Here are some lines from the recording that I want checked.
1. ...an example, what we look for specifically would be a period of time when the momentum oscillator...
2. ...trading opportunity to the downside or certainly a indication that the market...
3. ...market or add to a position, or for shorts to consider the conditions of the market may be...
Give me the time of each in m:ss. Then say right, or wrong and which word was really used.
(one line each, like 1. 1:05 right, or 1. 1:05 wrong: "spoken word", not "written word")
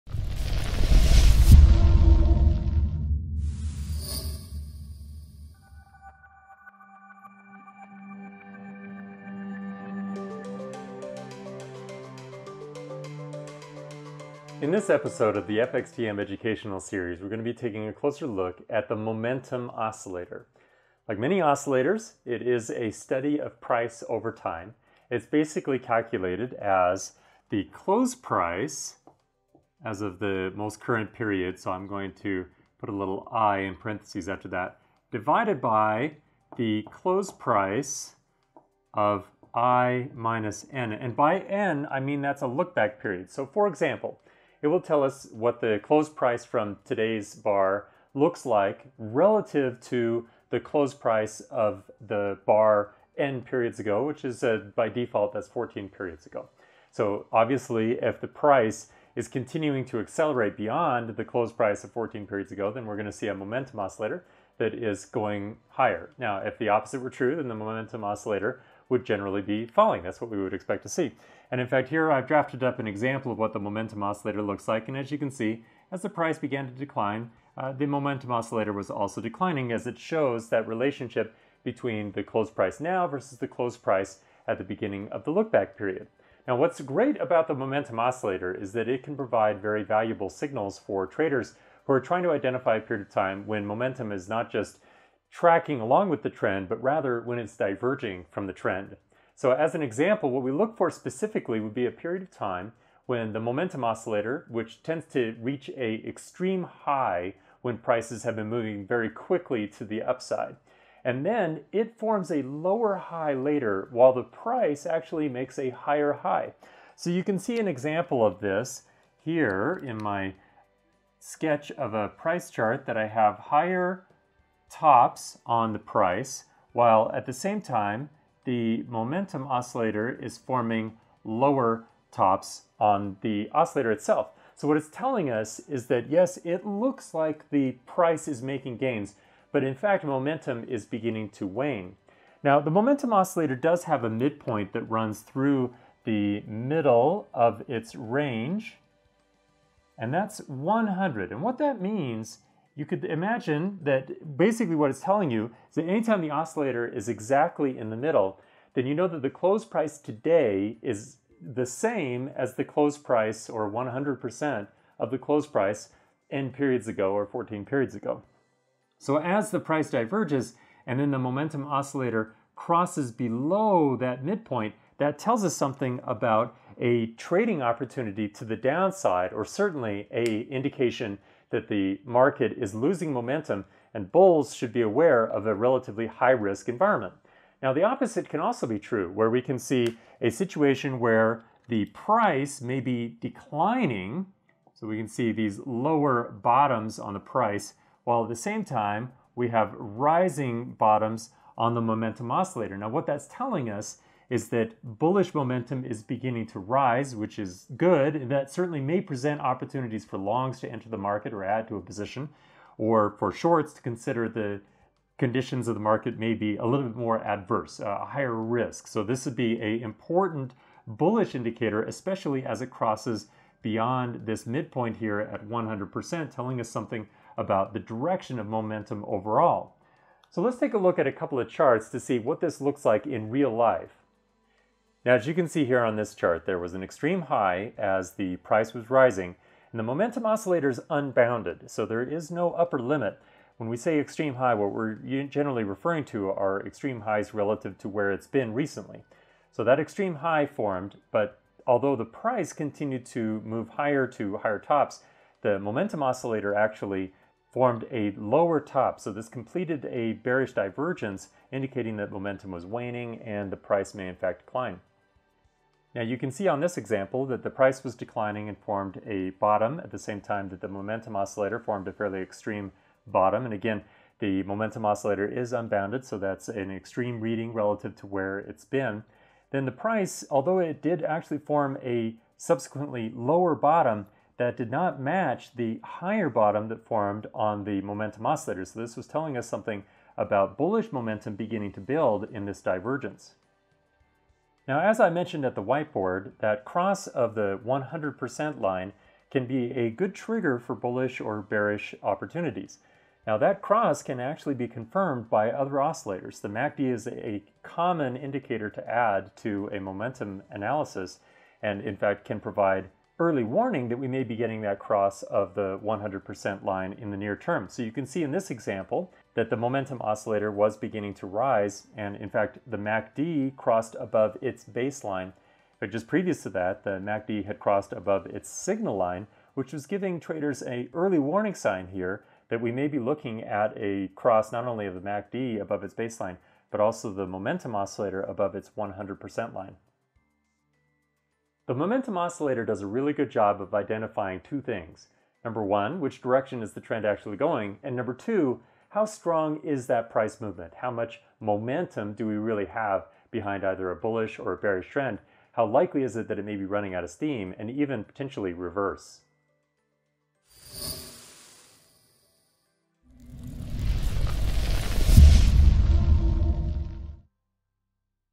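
1. 1:39 right
2. 2:57 right
3. 3:30 right.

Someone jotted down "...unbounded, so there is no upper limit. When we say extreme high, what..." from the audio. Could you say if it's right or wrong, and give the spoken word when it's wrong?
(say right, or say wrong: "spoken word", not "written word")
right.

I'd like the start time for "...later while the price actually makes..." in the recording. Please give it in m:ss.
1:53.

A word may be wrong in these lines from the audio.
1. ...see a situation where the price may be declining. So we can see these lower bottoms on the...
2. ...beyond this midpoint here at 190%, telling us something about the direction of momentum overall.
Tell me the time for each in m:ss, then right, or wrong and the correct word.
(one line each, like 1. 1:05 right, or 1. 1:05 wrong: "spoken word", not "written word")
1. 3:09 right
2. 3:43 wrong: "100", not "190".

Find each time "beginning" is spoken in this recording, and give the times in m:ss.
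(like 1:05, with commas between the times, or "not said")
1:24, 2:20, 3:26, 4:51, 5:20.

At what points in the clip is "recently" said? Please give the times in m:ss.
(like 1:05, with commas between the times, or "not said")
4:08.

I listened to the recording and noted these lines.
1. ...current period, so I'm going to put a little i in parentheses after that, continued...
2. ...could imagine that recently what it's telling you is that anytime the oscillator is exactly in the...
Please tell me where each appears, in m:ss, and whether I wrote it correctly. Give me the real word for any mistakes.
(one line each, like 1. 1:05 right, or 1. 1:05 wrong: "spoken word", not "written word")
1. 0:30 wrong: "divided", not "continued"
2. 2:32 wrong: "basically", not "recently".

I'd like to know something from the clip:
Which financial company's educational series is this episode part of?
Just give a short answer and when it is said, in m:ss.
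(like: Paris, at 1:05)
FXTM, at 0:15.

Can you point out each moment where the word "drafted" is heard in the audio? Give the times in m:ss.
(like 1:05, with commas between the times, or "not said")
1:12.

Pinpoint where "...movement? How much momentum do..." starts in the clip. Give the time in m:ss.
5:50.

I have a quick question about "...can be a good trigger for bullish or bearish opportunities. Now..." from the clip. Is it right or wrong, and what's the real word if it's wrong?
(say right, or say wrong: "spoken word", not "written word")
right.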